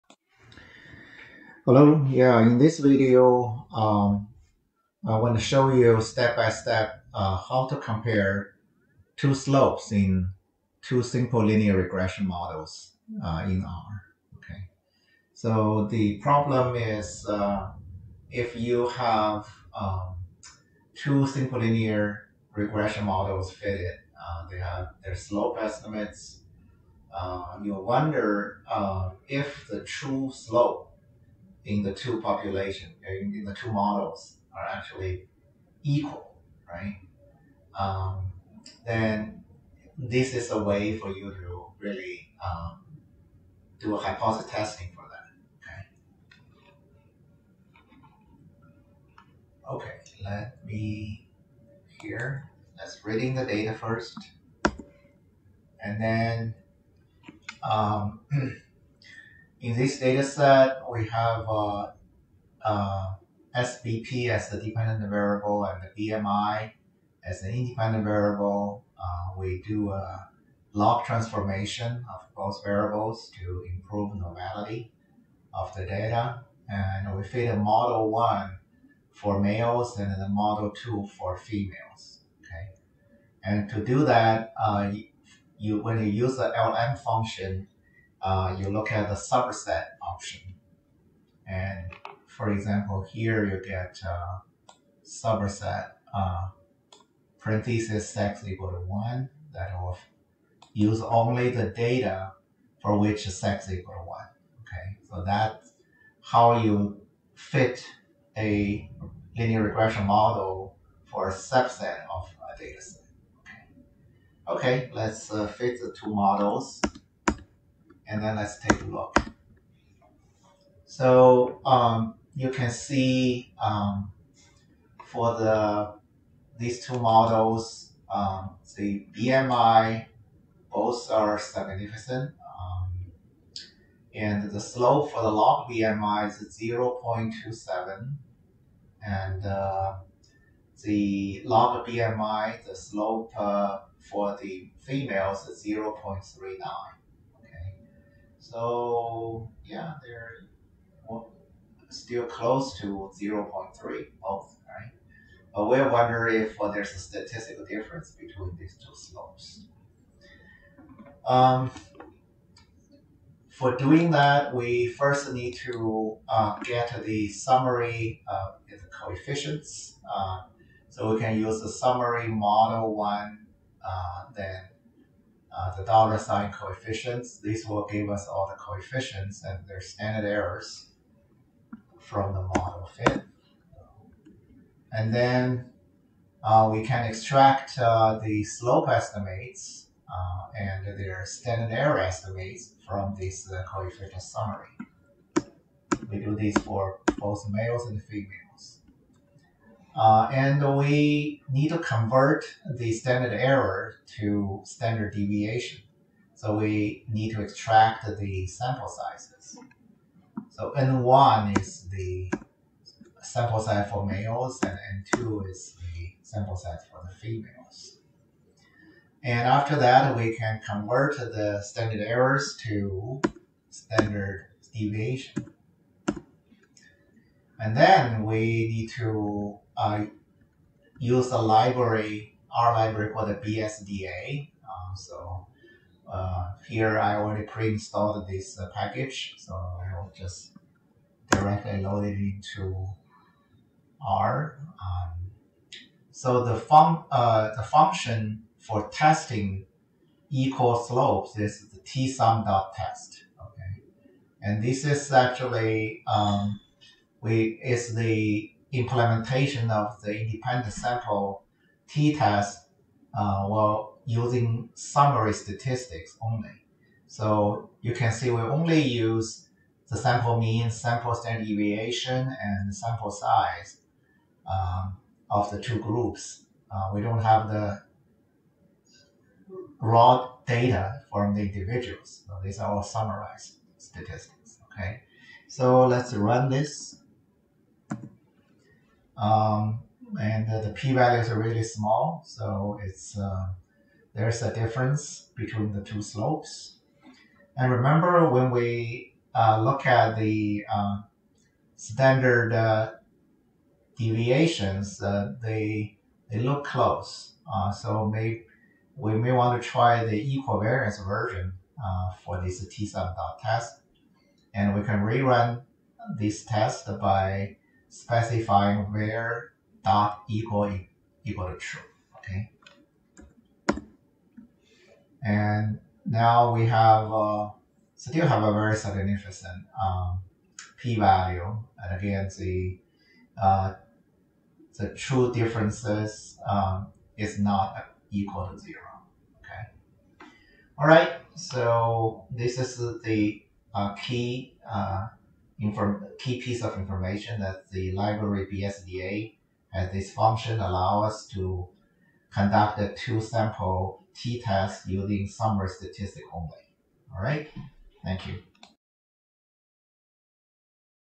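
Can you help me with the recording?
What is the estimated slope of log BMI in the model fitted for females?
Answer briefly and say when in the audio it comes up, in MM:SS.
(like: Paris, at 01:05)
0.39, at 02:25.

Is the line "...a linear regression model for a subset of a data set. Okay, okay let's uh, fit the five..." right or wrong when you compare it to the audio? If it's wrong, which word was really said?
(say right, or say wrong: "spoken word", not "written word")
wrong: "two", not "five".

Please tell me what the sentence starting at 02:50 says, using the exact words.
Uh, so we can use the summary model one, uh, then uh, the dollar sign coefficients.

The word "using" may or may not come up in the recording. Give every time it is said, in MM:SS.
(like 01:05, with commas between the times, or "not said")
04:24, 05:54.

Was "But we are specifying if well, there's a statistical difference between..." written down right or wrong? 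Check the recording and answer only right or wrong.
wrong.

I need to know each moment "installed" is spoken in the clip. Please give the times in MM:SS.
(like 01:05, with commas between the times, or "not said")
03:57.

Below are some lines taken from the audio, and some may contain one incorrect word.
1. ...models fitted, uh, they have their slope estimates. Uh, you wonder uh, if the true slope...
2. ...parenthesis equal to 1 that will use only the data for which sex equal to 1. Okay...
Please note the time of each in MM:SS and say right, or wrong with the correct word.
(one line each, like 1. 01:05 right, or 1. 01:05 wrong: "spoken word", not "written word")
1. 00:23 right
2. 01:37 right.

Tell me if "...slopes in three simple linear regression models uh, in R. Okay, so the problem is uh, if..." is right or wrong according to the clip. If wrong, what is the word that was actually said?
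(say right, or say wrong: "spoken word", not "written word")
wrong: "two", not "three".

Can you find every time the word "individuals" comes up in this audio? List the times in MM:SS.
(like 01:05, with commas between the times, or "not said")
04:41.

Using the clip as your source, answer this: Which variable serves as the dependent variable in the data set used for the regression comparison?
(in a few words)
SBP.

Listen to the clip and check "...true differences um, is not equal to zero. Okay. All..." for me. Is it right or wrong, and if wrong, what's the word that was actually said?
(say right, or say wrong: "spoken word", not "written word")
right.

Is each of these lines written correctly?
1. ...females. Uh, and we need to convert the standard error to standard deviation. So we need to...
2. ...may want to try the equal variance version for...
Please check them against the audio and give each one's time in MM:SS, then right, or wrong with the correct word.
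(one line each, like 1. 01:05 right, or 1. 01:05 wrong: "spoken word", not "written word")
1. 03:18 right
2. 05:09 right.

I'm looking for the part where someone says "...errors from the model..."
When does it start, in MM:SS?
03:00.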